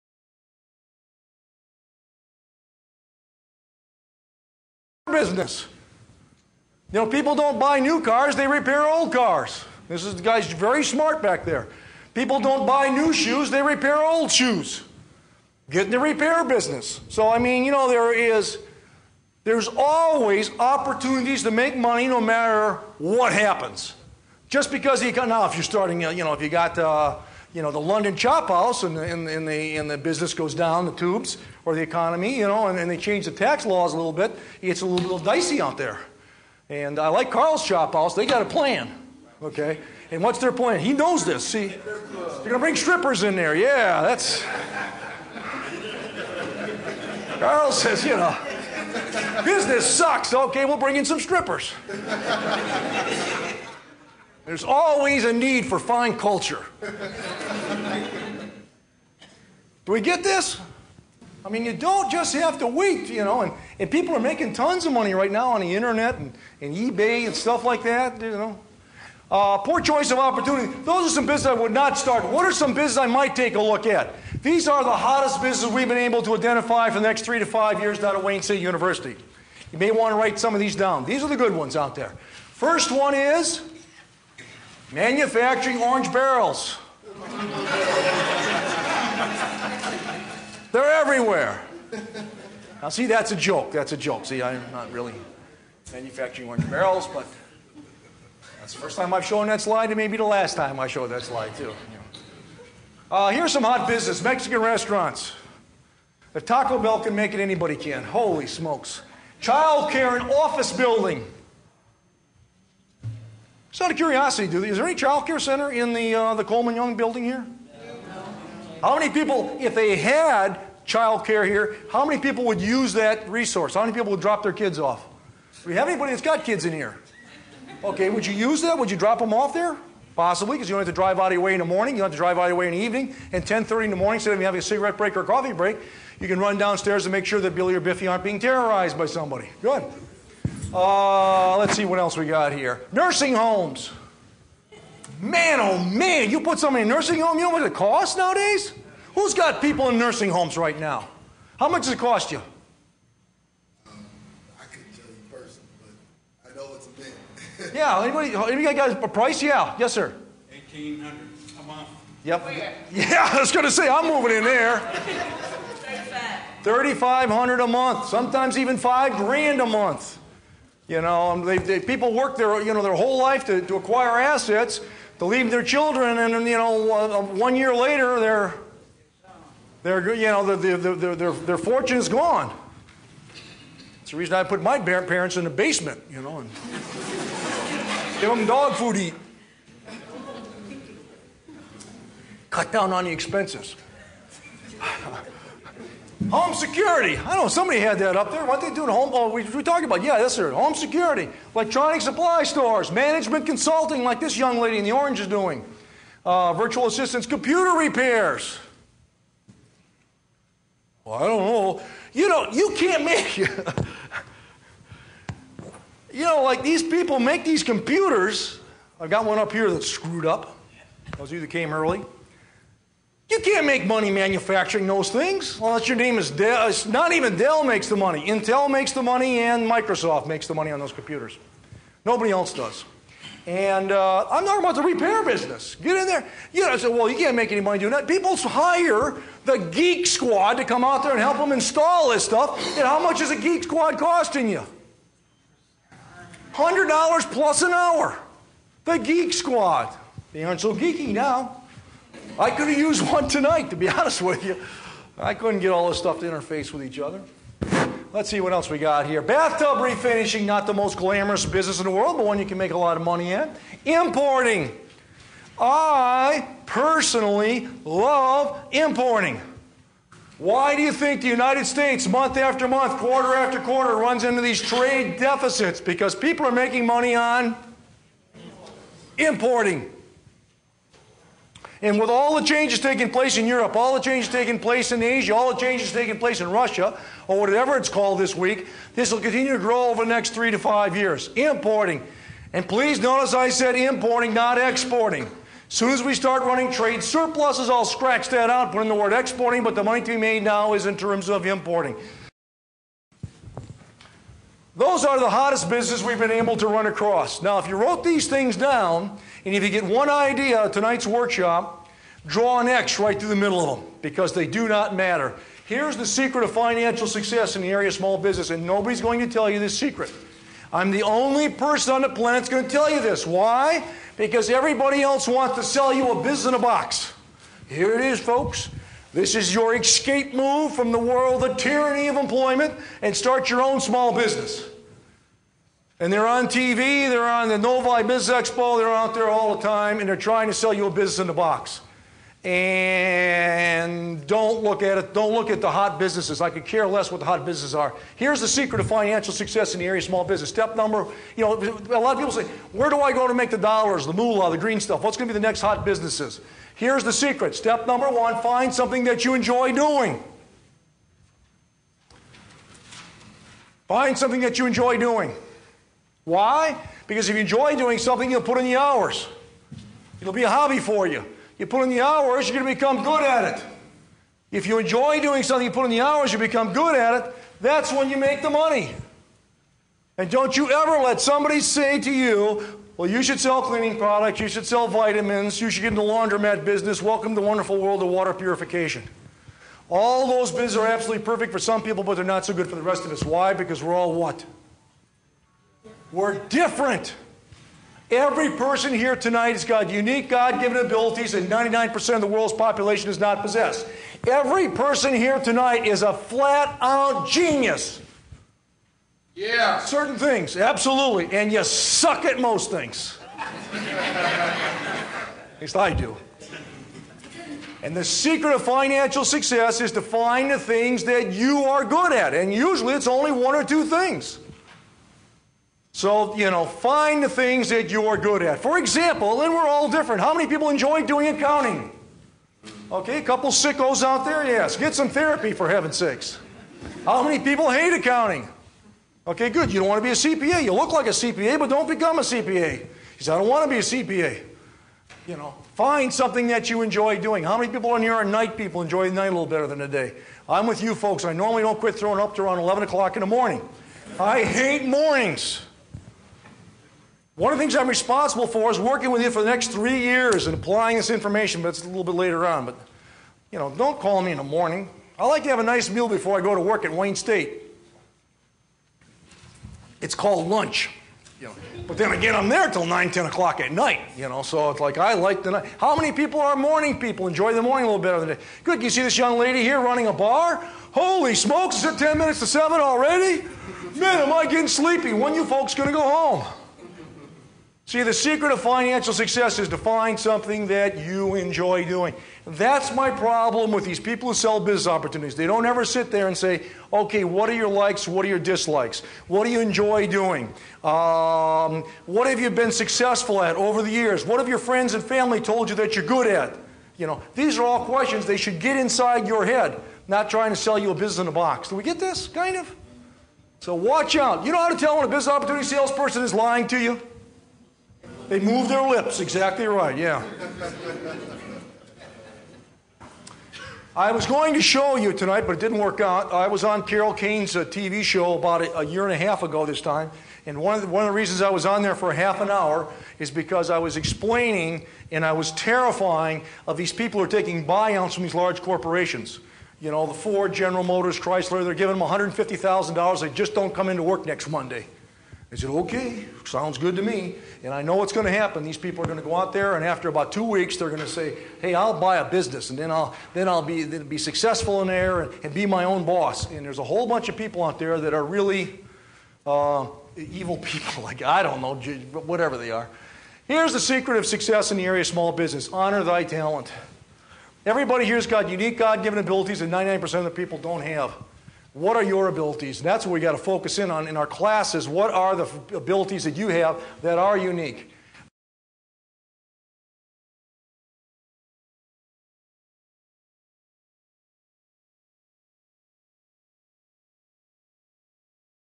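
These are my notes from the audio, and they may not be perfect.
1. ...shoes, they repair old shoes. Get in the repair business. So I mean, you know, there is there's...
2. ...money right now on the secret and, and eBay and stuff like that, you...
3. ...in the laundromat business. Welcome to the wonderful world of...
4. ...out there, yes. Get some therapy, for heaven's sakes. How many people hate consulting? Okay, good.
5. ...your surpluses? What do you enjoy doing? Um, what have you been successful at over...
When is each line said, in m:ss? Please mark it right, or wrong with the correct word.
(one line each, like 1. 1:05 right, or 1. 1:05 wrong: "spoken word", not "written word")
1. 0:13 right
2. 1:04 wrong: "internet", not "secret"
3. 6:25 right
4. 7:14 wrong: "accounting", not "consulting"
5. 8:18 wrong: "dislikes", not "surpluses".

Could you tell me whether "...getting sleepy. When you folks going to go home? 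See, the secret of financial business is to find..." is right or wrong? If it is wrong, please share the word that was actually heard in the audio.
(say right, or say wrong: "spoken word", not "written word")
wrong: "success", not "business".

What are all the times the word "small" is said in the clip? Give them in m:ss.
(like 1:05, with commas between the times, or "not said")
5:17, 5:33, 5:50, 9:25.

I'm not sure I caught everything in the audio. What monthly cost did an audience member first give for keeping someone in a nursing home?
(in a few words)
1800 a month.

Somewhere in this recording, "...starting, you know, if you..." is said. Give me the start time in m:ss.
0:25.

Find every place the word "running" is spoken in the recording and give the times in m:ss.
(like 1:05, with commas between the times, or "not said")
4:56, 7:59.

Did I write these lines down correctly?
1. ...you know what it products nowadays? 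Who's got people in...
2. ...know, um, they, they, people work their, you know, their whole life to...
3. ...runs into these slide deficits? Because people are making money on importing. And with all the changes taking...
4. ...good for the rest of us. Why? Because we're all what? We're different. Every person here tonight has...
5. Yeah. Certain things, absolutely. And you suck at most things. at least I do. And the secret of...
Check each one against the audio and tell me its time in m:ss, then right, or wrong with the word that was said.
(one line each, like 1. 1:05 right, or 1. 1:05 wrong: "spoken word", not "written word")
1. 2:27 wrong: "costs", not "products"
2. 2:51 right
3. 4:33 wrong: "trade", not "slide"
4. 6:32 right
5. 6:49 right.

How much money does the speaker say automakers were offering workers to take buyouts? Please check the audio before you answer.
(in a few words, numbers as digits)
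$150,000.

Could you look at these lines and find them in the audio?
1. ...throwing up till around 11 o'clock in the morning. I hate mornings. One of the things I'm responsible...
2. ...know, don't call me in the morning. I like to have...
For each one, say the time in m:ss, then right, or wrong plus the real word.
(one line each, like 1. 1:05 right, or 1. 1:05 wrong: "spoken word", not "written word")
1. 7:31 right
2. 7:43 right.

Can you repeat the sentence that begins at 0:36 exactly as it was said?
And I like Carl's chop house.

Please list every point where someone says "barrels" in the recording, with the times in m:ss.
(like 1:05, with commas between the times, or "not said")
1:26, 1:36.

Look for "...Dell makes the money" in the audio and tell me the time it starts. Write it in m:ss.
3:47.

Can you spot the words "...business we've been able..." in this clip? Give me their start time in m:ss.
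5:05.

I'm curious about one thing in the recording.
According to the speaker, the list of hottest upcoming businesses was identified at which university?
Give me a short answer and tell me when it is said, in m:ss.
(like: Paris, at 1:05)
Wayne State University, at 1:18.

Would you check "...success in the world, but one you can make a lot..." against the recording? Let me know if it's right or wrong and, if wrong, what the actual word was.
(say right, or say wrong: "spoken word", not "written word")
wrong: "business", not "success".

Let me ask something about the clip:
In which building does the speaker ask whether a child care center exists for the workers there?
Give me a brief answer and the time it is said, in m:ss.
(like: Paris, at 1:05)
Coleman Young building, at 1:56.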